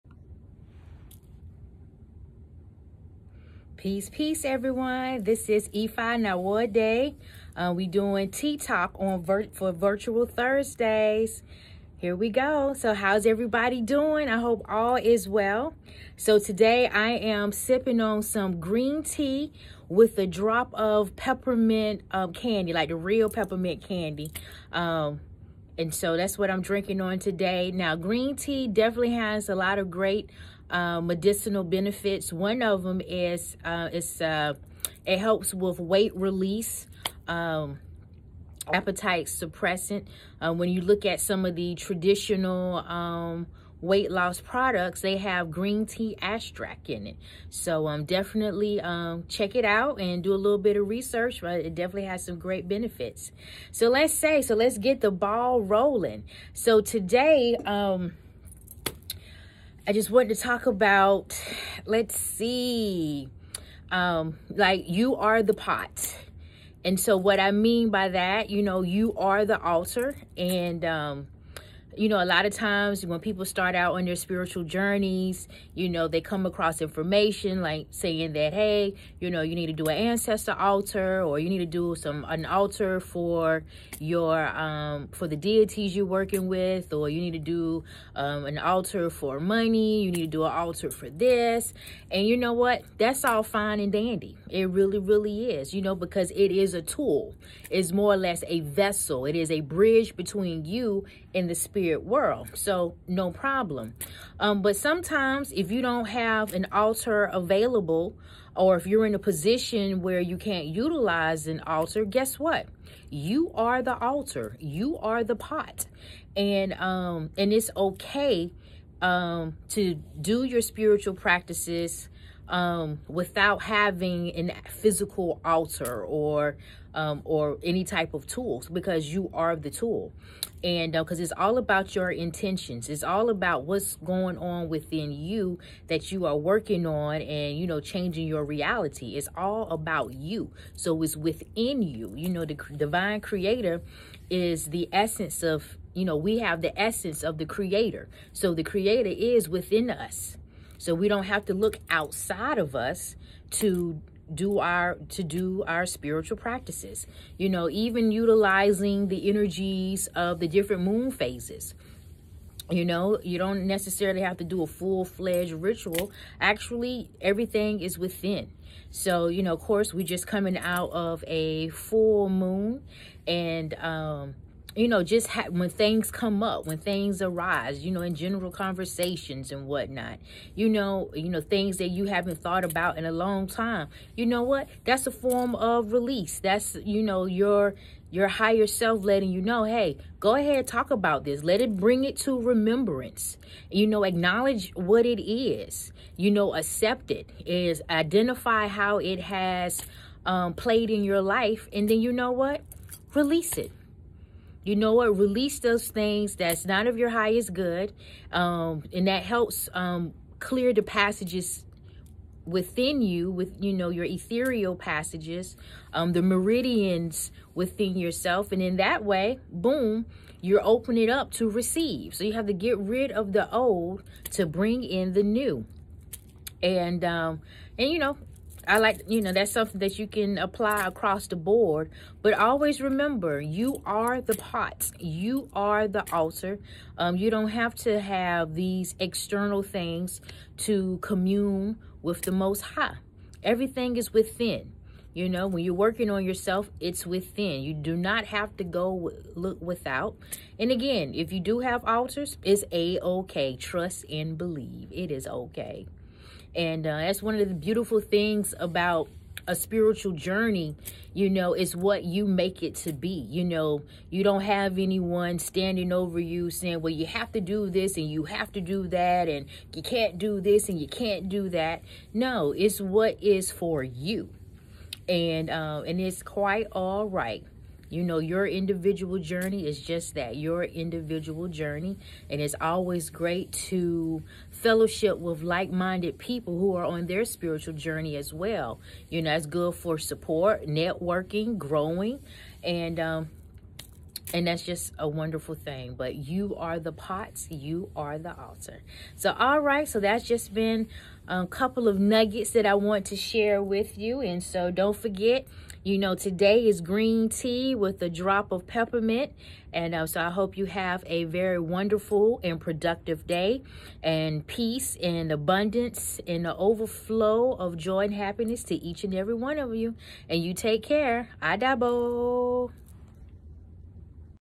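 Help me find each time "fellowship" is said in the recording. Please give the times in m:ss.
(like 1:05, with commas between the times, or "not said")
4:44.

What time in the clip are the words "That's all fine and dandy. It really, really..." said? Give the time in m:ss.
1:32.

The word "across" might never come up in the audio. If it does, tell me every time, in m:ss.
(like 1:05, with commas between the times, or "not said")
1:16, 3:50.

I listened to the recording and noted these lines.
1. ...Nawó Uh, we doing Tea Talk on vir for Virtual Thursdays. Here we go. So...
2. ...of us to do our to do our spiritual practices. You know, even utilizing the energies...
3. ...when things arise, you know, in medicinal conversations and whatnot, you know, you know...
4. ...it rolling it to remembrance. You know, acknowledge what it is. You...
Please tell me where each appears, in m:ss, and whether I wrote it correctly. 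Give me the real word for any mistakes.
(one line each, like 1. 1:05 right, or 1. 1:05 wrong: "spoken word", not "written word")
1. 0:06 right
2. 2:32 right
3. 2:56 wrong: "general", not "medicinal"
4. 3:11 wrong: "bring", not "rolling".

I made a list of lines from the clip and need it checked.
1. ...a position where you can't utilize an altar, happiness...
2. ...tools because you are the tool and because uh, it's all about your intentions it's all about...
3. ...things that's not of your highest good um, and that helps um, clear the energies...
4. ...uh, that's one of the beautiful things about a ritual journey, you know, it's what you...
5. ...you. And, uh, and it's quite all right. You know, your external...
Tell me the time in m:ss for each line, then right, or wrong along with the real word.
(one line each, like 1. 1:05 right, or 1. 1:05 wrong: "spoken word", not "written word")
1. 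1:49 wrong: "guess", not "happiness"
2. 2:08 right
3. 3:25 wrong: "passages", not "energies"
4. 4:16 wrong: "spiritual", not "ritual"
5. 4:33 wrong: "individual", not "external".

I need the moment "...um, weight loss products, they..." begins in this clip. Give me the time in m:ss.
0:42.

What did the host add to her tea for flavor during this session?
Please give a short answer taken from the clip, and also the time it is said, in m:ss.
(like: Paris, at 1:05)
Peppermint candy, at 0:21.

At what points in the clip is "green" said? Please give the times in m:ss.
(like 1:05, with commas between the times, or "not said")
0:18, 0:27, 0:45, 5:06.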